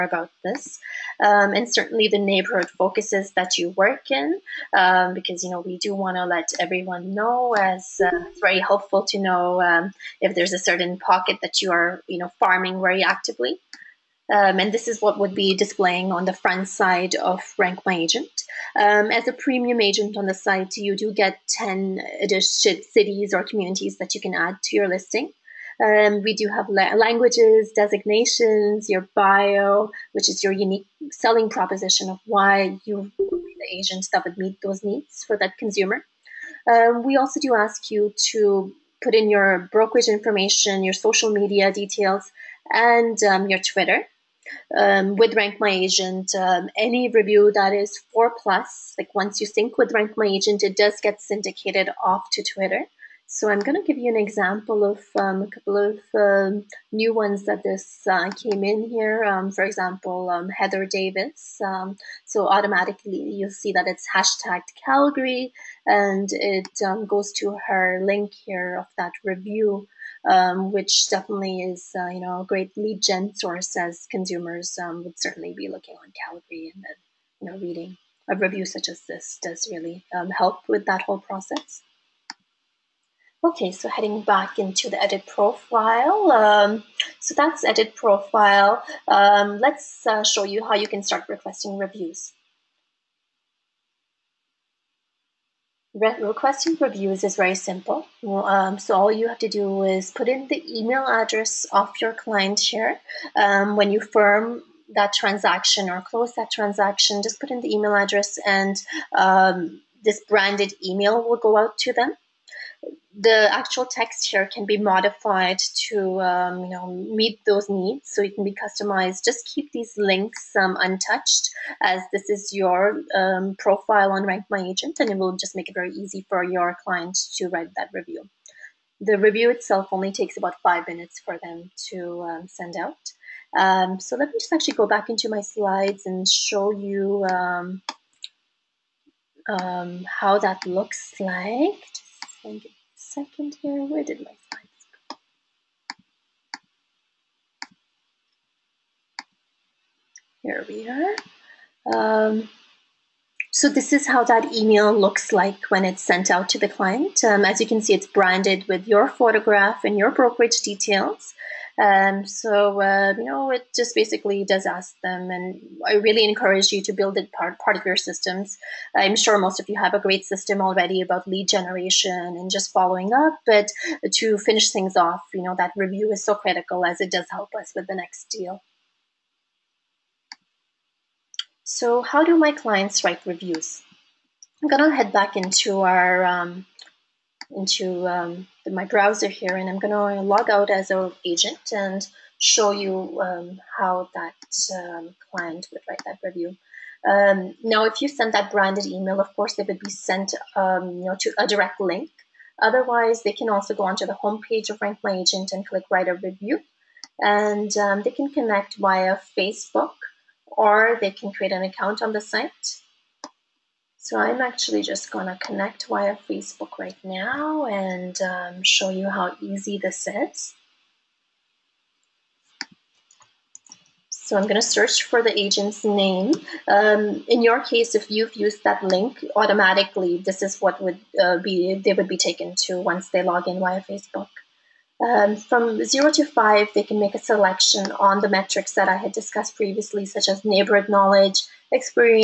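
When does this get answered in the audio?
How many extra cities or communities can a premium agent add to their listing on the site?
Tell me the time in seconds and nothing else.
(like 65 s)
21 s.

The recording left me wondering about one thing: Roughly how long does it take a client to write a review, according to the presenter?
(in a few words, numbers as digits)
5 minutes.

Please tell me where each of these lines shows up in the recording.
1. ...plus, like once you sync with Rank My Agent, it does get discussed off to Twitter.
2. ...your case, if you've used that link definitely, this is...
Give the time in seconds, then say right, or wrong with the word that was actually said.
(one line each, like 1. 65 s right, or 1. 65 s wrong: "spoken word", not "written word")
1. 48 s wrong: "syndicated", not "discussed"
2. 227 s wrong: "automatically", not "definitely".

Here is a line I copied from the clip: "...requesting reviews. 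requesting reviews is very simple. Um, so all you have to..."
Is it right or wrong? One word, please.
right.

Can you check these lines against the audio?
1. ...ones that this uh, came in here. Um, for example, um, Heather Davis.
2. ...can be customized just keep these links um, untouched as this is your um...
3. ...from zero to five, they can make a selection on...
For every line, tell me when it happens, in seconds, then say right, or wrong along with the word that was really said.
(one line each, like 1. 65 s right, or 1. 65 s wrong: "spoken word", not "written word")
1. 57 s right
2. 118 s right
3. 235 s right.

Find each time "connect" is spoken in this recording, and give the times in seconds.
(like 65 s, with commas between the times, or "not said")
208 s, 215 s.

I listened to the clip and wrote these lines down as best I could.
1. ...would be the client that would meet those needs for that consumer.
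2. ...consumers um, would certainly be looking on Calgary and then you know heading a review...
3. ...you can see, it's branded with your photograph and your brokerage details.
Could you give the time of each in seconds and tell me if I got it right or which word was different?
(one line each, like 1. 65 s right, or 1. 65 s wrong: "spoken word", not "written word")
1. 33 s wrong: "agent", not "client"
2. 74 s wrong: "reading", not "heading"
3. 157 s right.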